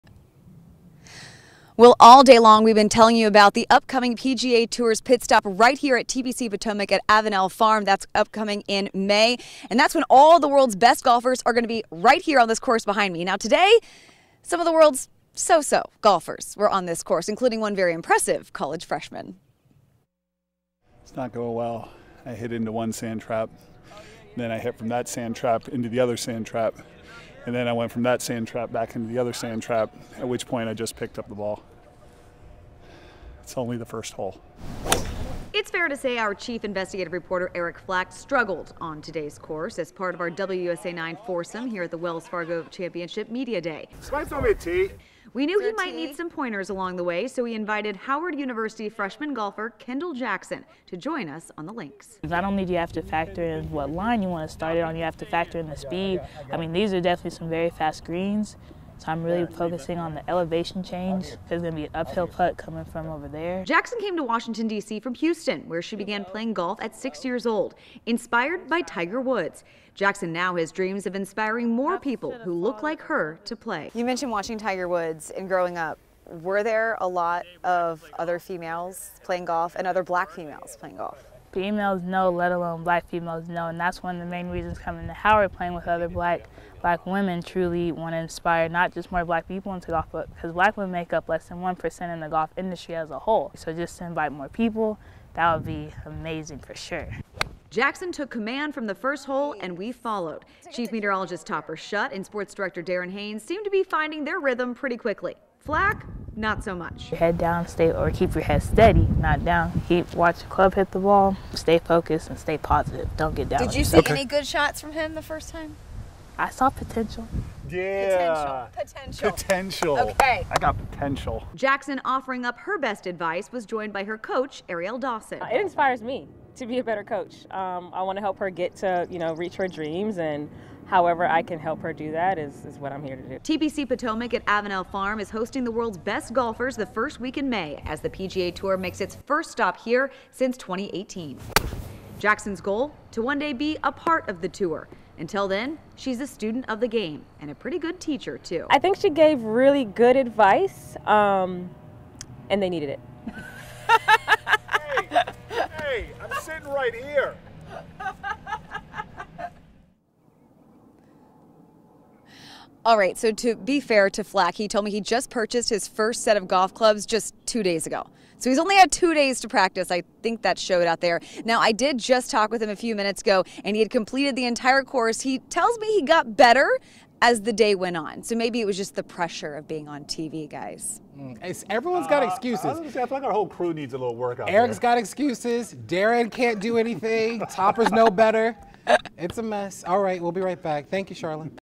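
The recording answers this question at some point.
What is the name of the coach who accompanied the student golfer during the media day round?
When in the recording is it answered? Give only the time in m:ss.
2:04.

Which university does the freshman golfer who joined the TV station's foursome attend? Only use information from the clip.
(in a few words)
Howard University.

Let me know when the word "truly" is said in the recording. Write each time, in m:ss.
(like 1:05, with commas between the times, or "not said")
1:27.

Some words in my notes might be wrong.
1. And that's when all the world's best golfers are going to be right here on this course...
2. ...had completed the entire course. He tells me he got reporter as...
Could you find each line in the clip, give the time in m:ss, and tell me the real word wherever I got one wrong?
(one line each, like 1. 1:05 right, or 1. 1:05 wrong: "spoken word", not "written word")
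1. 0:09 right
2. 2:53 wrong: "better", not "reporter".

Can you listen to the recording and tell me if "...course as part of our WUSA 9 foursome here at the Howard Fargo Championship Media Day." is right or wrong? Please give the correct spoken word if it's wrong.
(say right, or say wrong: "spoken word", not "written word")
wrong: "Wells", not "Howard".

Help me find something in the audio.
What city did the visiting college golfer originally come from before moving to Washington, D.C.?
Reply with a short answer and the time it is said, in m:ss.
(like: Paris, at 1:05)
Houston, at 1:05.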